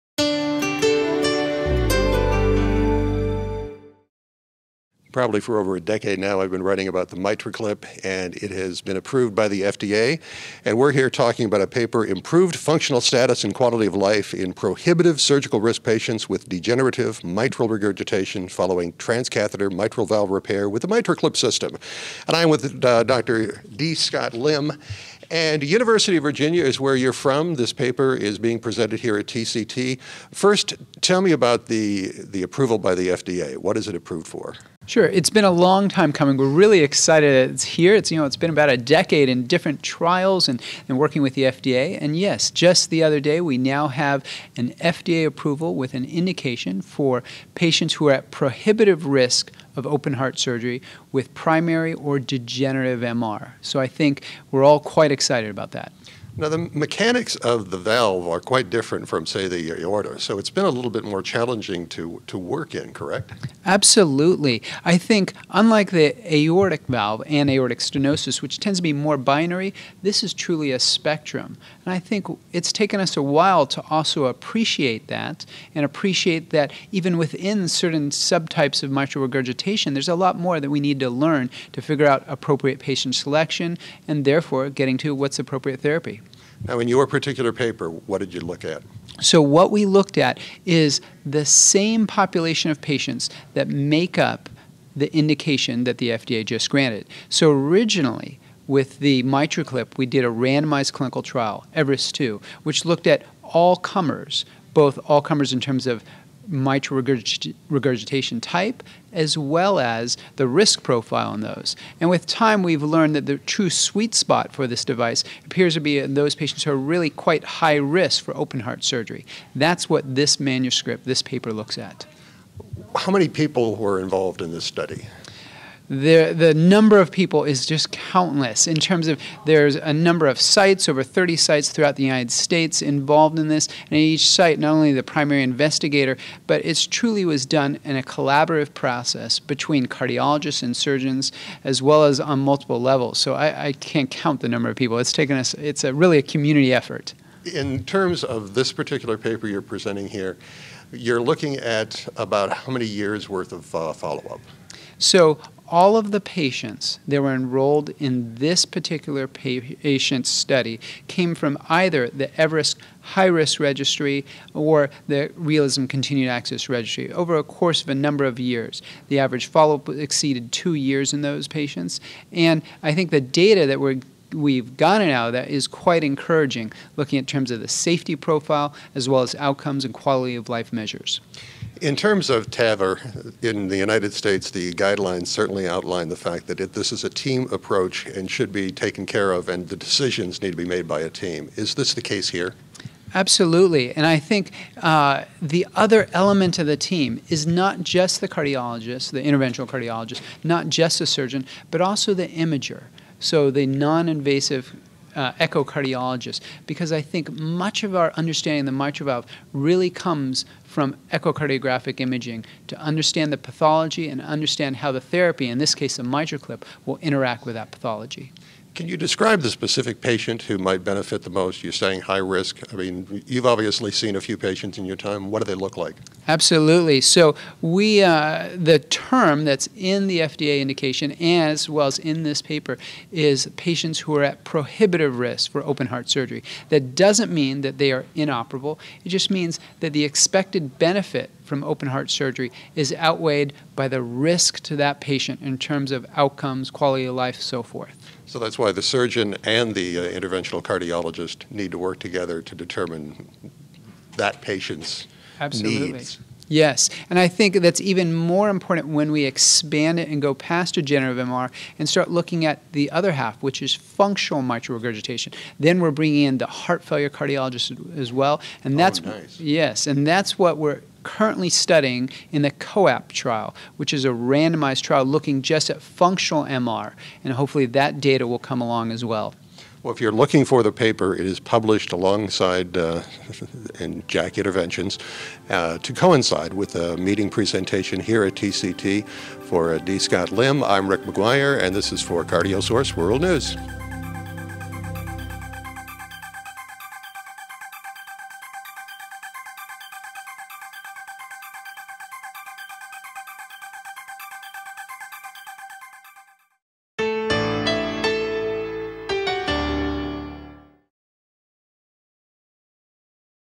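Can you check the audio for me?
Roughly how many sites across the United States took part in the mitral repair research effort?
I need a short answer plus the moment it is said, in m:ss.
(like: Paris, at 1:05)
over 30, at 2:10.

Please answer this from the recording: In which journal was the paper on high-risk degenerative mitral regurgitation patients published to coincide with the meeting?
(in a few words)
JACC Interventions.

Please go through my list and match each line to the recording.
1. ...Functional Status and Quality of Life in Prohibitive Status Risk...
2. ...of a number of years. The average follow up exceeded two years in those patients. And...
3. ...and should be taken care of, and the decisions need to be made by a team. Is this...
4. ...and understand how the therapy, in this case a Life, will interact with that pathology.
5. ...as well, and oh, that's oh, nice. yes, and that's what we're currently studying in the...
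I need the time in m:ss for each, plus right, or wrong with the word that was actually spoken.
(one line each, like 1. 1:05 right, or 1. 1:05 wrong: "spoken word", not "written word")
1. 0:12 wrong: "Surgical", not "Status"
2. 2:47 right
3. 3:08 right
4. 3:34 wrong: "MitraClip", not "Life"
5. 4:27 right.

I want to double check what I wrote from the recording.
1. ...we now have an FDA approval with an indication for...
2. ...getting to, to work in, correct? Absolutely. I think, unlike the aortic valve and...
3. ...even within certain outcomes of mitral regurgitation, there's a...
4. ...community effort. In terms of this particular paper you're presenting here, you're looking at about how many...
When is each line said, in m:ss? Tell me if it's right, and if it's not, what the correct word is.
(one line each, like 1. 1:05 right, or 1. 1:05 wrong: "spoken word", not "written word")
1. 0:43 right
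2. 1:01 wrong: "challenging", not "getting"
3. 1:16 wrong: "subtypes", not "outcomes"
4. 2:26 right.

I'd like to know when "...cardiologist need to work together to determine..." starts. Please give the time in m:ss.
4:10.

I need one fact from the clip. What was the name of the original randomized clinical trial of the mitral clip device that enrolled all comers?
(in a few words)
Everest 2.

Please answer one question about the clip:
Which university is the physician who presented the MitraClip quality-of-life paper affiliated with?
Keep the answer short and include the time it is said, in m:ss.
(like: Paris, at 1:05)
University of Virginia, at 0:25.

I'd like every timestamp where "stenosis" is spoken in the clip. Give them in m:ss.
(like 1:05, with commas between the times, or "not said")
1:07.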